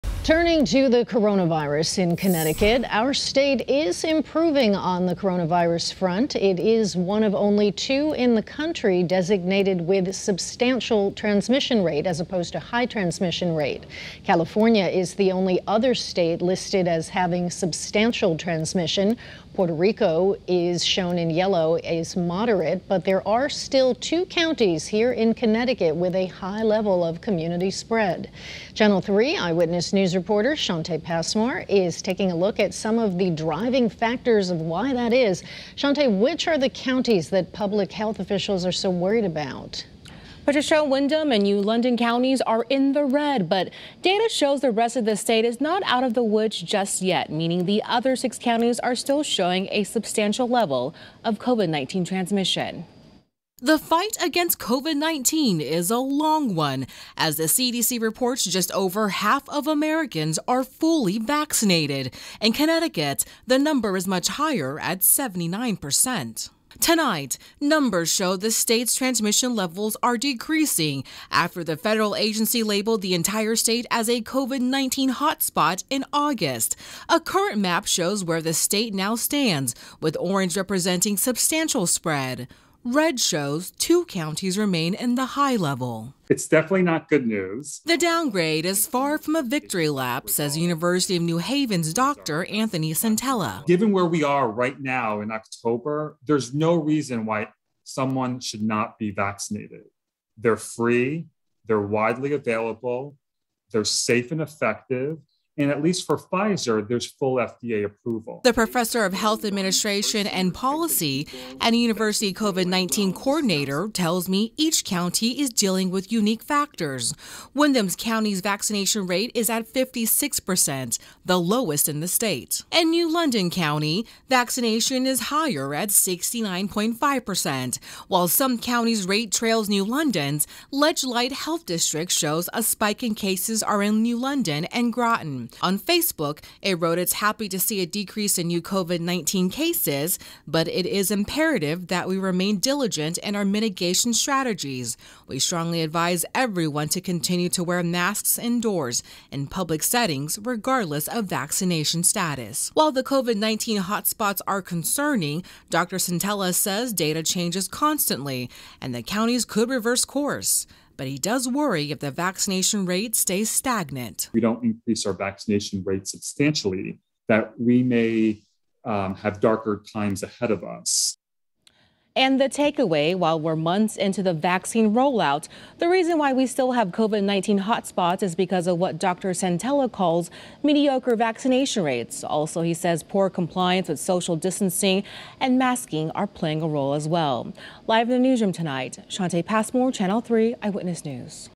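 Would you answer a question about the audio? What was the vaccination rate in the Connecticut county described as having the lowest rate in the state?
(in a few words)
56%.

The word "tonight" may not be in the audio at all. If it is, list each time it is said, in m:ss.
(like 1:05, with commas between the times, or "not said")
1:06, 3:08.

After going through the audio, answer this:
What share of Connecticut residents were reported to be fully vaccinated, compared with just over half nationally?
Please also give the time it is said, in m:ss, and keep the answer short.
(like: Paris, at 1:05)
79%, at 1:04.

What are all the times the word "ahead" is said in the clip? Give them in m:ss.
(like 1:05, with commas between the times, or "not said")
2:50.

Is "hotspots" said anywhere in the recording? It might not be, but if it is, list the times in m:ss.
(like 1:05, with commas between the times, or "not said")
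1:15, 2:33, 2:57.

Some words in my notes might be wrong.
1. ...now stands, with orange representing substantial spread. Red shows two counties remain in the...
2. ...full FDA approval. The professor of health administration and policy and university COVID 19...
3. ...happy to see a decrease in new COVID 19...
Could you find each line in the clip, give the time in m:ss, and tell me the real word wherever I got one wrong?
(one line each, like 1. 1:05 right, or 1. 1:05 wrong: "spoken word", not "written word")
1. 1:18 right
2. 1:47 right
3. 2:17 right.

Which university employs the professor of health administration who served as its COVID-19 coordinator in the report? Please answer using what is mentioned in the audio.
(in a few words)
University of New Haven.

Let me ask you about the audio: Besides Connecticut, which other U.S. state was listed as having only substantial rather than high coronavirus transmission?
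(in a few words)
California.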